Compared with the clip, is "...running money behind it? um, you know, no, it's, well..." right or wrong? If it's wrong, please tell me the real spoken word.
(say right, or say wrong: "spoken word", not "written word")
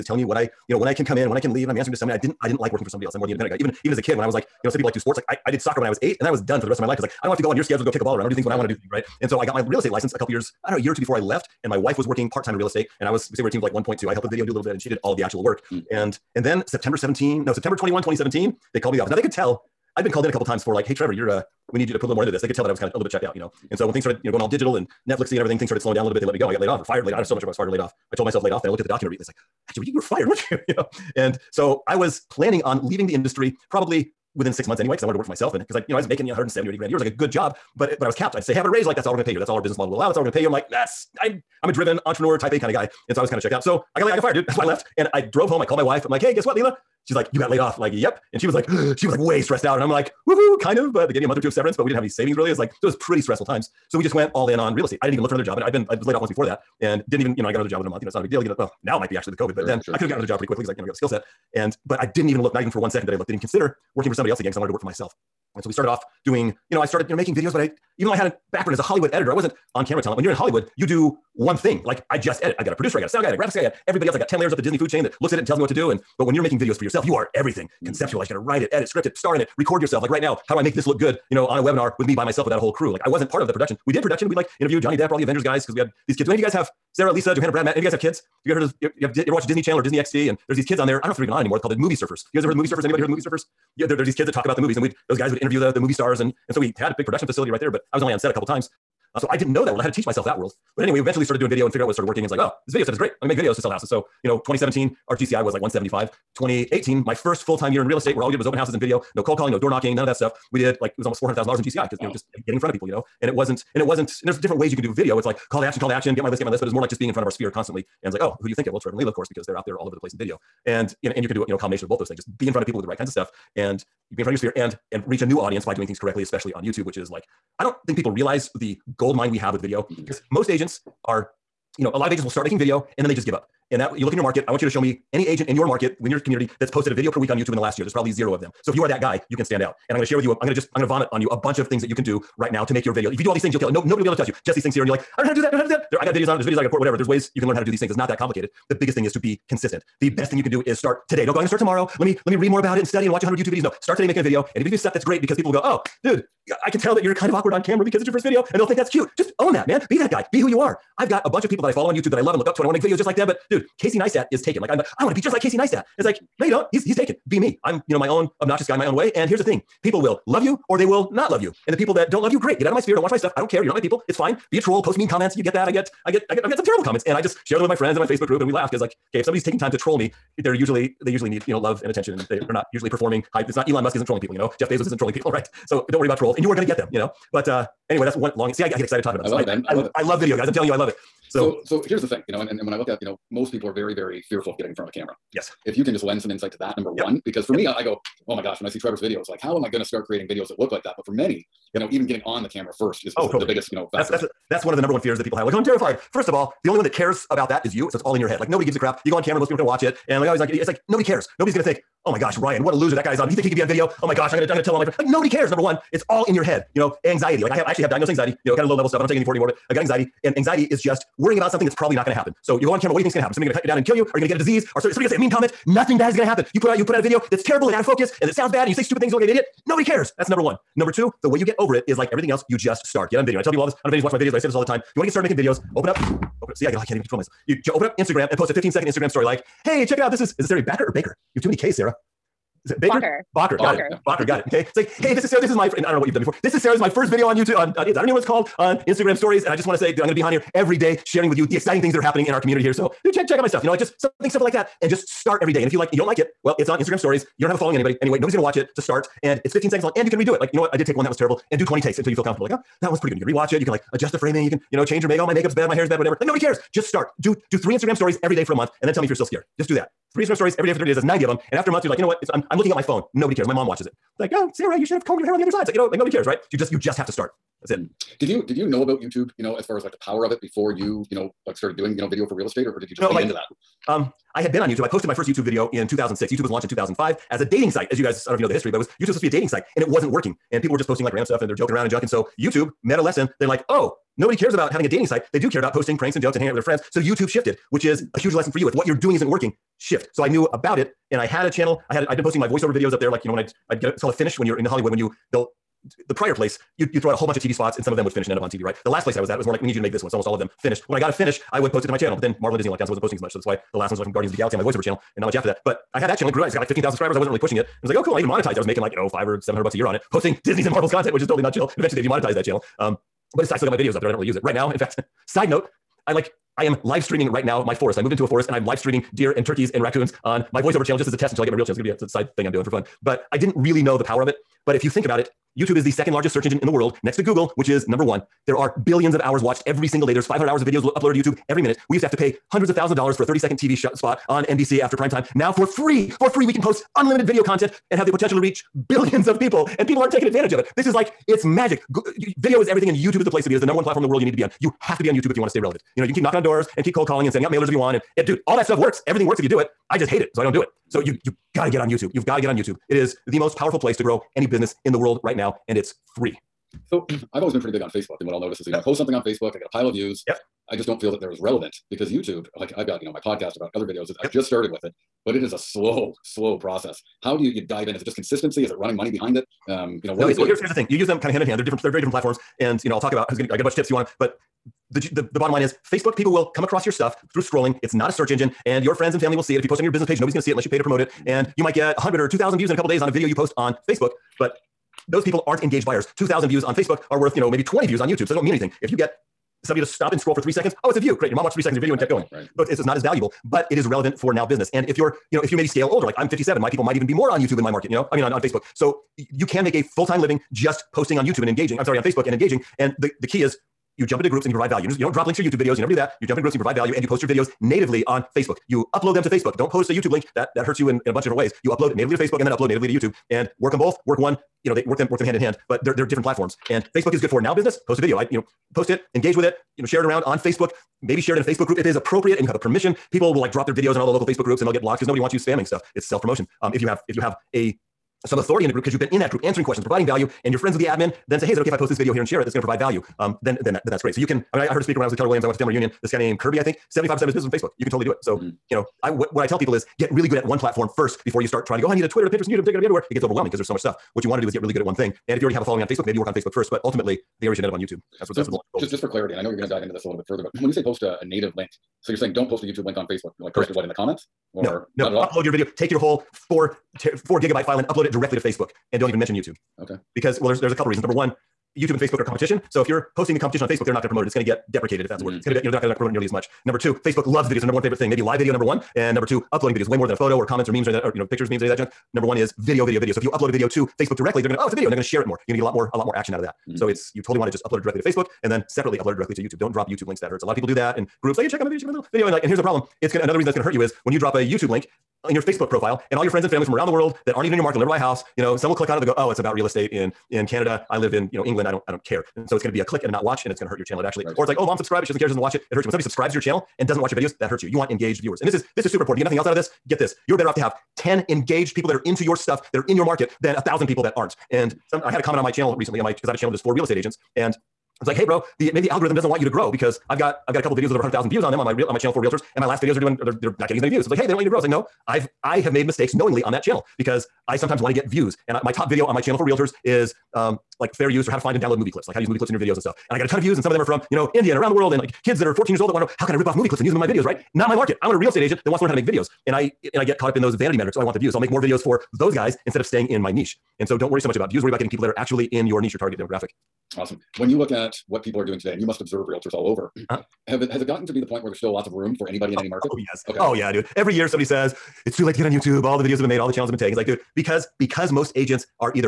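right.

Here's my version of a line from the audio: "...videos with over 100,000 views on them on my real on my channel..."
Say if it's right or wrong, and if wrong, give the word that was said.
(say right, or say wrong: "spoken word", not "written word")
right.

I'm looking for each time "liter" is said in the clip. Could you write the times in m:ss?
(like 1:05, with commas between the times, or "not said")
not said.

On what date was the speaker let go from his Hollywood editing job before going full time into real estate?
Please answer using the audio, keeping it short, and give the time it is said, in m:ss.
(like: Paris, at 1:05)
September 21, 2017, at 0:17.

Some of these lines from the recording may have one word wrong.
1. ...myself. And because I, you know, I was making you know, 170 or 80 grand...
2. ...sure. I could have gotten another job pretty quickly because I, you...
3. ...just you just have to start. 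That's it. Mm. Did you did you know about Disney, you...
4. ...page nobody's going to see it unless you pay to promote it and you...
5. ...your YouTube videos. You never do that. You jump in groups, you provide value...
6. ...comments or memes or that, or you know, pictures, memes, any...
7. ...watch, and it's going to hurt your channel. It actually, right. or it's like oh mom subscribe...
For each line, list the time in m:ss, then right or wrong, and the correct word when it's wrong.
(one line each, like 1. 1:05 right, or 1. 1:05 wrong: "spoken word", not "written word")
1. 0:35 right
2. 0:59 right
3. 4:36 wrong: "YouTube", not "Disney"
4. 6:30 right
5. 6:55 right
6. 8:00 right
7. 8:23 right.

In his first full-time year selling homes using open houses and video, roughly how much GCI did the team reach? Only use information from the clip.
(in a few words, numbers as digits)
400,000 dollars.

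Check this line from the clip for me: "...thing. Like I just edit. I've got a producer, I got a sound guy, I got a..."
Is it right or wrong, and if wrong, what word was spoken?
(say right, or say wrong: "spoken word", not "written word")
right.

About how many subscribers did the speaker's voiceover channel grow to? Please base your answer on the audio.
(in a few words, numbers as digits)
15,000.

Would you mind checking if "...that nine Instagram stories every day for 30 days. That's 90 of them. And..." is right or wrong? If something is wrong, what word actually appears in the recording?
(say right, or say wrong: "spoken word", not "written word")
wrong: "three", not "nine".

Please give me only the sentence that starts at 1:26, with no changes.
Do any of you guys have Sarah, Lisa, Johanna, Brad, Matt?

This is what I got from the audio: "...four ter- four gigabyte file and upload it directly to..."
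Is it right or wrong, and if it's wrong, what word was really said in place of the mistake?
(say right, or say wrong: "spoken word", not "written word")
right.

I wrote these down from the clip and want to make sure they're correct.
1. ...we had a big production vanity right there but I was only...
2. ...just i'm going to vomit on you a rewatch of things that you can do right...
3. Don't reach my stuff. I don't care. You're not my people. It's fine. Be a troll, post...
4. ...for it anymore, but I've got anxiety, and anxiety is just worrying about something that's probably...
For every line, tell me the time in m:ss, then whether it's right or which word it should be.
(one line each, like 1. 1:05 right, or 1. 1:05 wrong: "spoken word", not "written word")
1. 1:36 wrong: "facility", not "vanity"
2. 2:20 wrong: "bunch", not "rewatch"
3. 2:52 wrong: "watch", not "reach"
4. 3:39 right.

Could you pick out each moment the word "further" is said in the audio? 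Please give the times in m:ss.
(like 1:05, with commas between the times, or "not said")
7:40.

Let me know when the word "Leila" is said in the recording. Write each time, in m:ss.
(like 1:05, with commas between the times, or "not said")
0:46, 1:58.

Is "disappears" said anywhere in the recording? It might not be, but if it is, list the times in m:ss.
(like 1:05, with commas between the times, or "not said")
not said.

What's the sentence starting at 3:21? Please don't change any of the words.
you know, even getting on the camera first is, is oh, the, totally.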